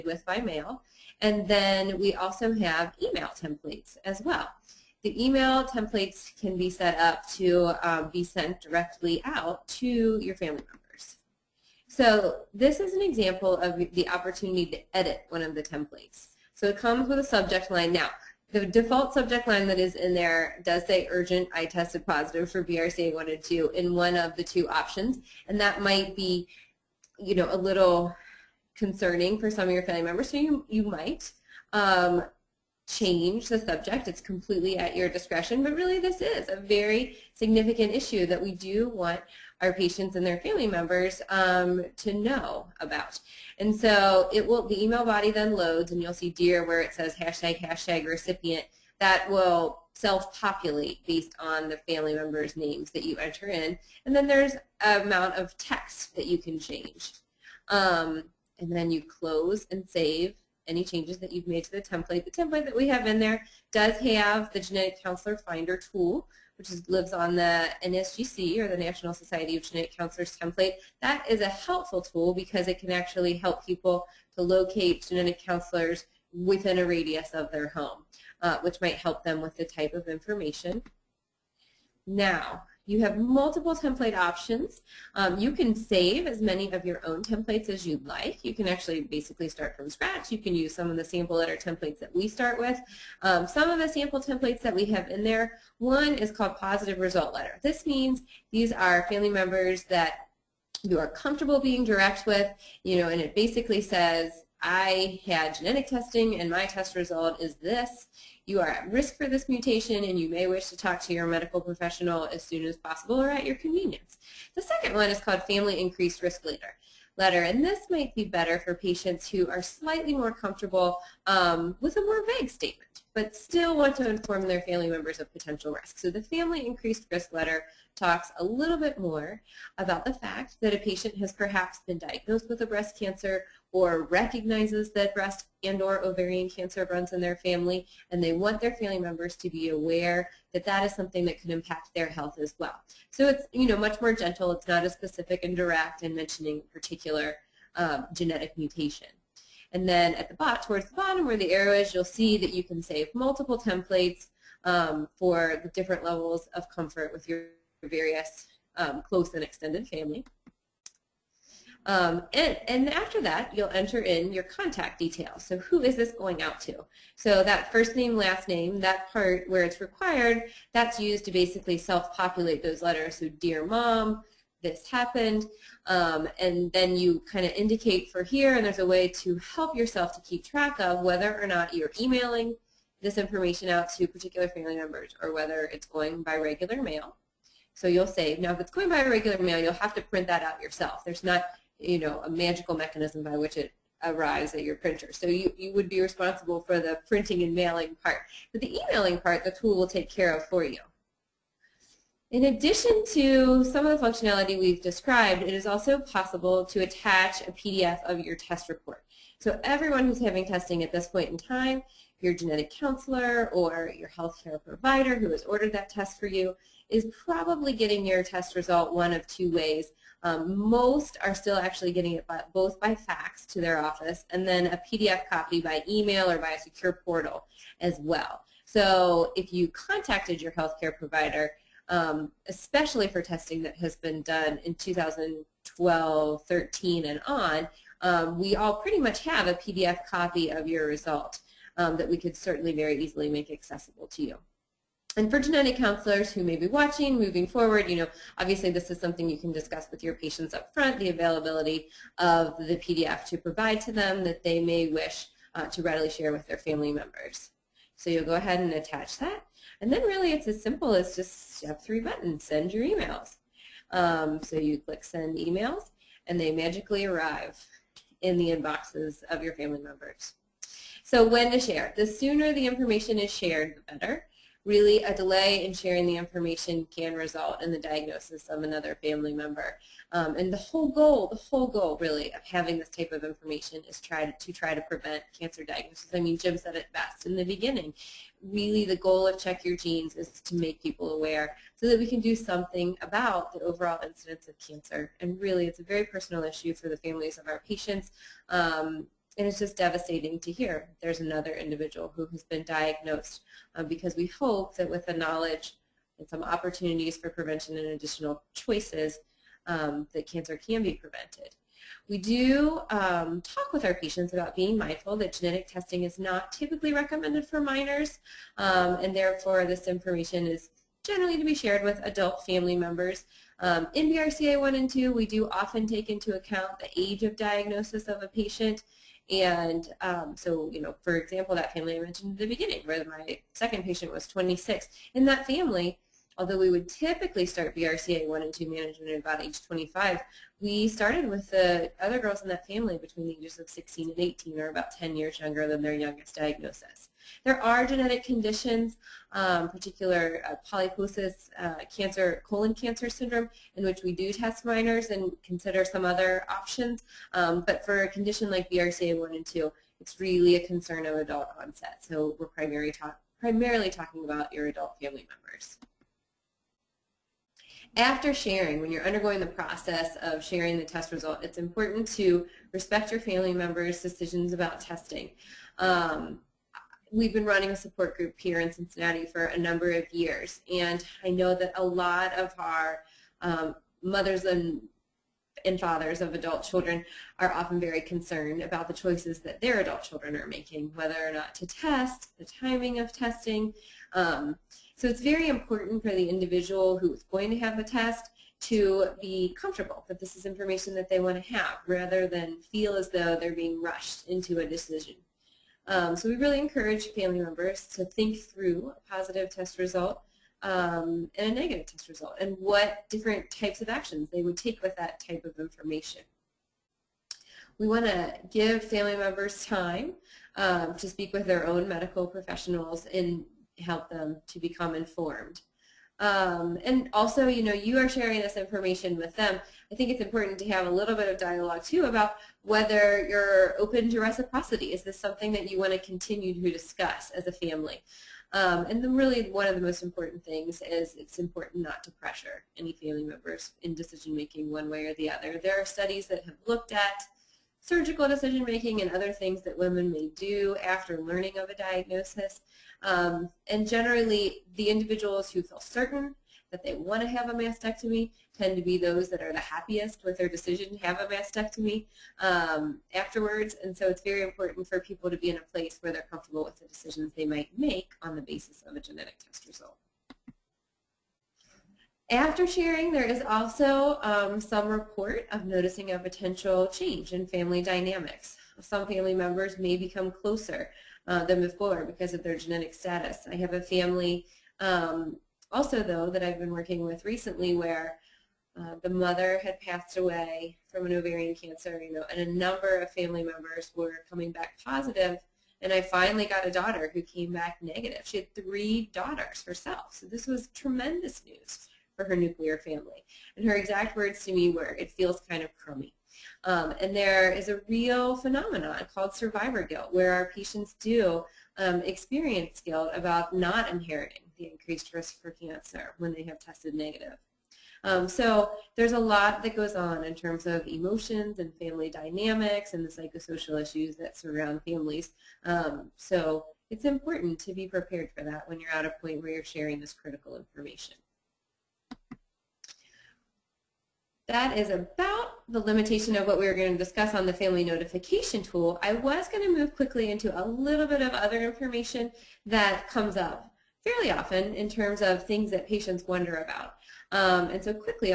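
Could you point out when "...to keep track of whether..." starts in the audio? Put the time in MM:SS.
03:00.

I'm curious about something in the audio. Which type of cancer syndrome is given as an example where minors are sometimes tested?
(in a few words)
Polyposis.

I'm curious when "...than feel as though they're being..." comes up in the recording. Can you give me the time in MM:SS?
06:42.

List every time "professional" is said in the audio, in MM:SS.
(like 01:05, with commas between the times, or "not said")
01:51, 07:02.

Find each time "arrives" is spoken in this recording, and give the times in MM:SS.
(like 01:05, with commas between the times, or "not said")
03:14, 04:27.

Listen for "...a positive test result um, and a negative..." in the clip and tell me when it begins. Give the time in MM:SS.
06:48.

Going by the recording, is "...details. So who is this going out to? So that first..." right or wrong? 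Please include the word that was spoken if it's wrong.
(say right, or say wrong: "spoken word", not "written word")
right.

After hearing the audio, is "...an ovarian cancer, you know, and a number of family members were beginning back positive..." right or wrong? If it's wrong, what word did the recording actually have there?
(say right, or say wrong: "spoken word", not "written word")
wrong: "coming", not "beginning".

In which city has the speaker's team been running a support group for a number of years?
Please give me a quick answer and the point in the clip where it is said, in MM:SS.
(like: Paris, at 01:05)
Cincinnati, at 06:18.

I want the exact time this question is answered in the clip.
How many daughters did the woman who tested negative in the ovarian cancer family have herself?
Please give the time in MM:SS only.
08:18.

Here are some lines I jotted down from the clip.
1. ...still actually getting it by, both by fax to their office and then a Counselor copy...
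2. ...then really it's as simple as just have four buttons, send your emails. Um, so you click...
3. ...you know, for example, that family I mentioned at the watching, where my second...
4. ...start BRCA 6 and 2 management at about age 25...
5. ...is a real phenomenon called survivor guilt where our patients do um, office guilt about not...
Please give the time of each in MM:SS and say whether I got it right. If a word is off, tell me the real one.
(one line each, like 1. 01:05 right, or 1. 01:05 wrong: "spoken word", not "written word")
1. 03:41 wrong: "PDF", not "Counselor"
2. 04:19 wrong: "three", not "four"
3. 05:30 wrong: "beginning", not "watching"
4. 05:37 wrong: "1", not "6"
5. 08:27 wrong: "experience", not "office".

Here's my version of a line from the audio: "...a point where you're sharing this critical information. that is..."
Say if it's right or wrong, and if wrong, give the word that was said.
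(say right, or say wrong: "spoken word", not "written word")
right.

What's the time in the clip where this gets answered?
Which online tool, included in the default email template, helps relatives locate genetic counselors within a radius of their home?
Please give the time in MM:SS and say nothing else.
01:04.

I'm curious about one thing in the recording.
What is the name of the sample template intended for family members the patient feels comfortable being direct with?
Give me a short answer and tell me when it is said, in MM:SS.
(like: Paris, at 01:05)
Positive result letter, at 01:36.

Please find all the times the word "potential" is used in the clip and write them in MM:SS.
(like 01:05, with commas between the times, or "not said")
02:05, 07:56.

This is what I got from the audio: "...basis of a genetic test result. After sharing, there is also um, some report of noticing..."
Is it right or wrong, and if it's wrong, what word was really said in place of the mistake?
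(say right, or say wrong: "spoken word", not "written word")
right.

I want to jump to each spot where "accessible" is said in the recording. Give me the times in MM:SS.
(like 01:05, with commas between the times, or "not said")
04:03.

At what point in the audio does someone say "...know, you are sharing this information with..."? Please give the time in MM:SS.
07:07.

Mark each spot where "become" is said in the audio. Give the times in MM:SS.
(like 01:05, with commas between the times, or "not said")
07:04, 07:59.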